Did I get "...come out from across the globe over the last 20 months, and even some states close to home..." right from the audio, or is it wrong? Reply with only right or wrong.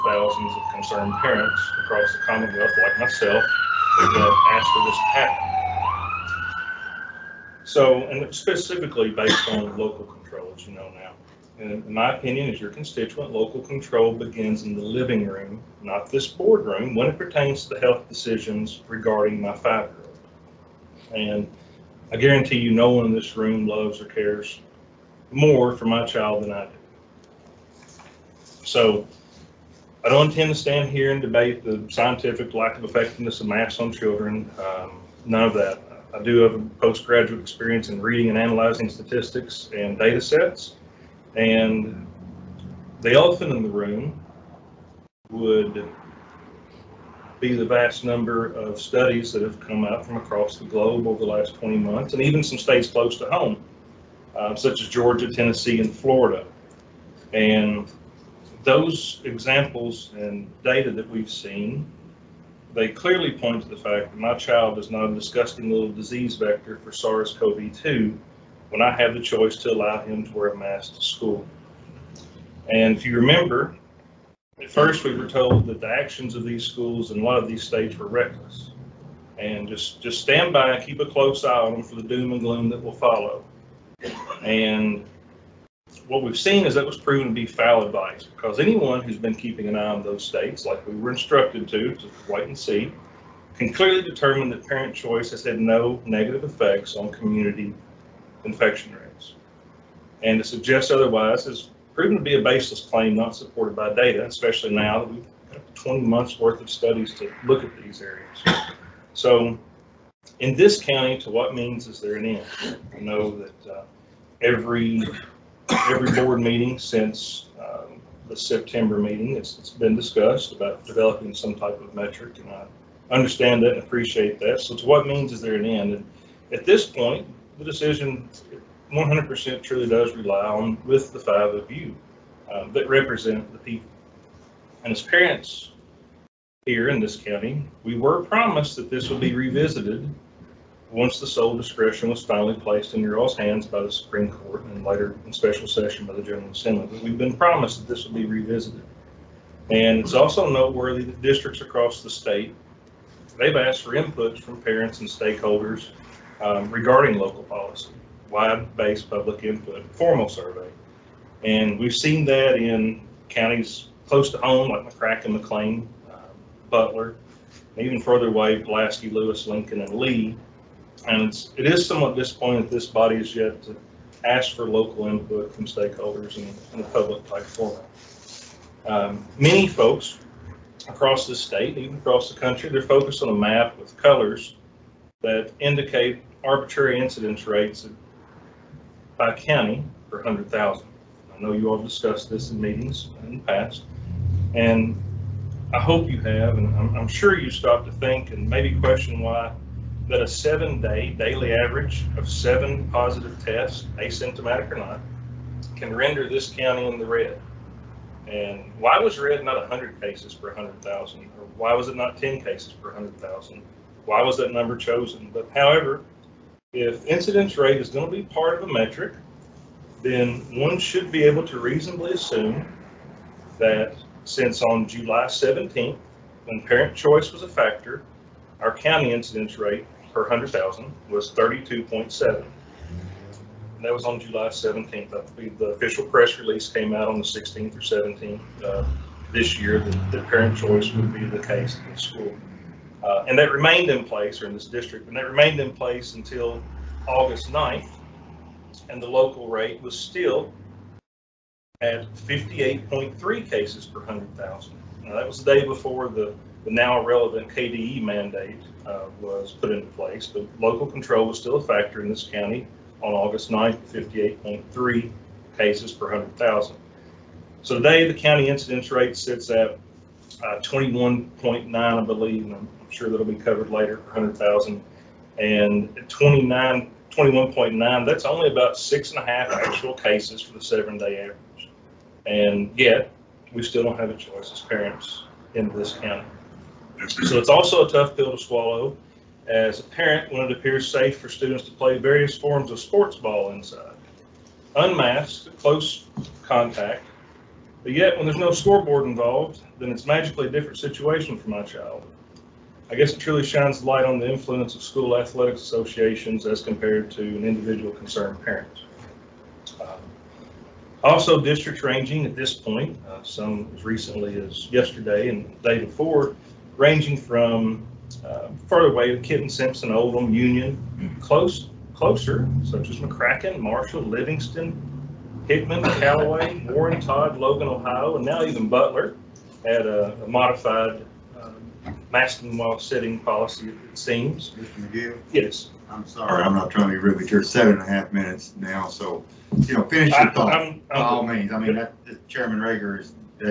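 right.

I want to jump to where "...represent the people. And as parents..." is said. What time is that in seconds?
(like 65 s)
132 s.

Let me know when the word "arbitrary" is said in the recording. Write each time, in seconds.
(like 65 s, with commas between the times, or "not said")
186 s.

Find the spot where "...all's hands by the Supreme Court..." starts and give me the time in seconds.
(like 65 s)
143 s.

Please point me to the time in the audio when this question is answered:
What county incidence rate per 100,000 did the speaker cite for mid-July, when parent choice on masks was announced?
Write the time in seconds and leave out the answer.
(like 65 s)
231 s.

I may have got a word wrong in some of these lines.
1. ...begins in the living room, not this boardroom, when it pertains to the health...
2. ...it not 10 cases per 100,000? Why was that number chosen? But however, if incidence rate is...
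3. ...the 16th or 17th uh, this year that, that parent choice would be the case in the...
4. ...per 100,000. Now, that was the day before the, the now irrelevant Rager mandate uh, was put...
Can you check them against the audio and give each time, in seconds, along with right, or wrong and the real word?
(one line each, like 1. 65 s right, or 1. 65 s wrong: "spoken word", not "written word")
1. 14 s right
2. 211 s right
3. 237 s right
4. 253 s wrong: "KDE", not "Rager".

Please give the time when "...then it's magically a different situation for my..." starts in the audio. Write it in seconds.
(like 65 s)
299 s.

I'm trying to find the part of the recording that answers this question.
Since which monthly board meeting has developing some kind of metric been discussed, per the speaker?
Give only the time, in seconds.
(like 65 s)
118 s.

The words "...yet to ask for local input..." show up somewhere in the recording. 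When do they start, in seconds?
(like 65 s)
173 s.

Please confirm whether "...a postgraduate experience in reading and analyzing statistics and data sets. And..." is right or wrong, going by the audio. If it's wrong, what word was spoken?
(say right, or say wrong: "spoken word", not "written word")
right.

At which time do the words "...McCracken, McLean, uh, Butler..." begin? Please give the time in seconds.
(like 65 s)
164 s.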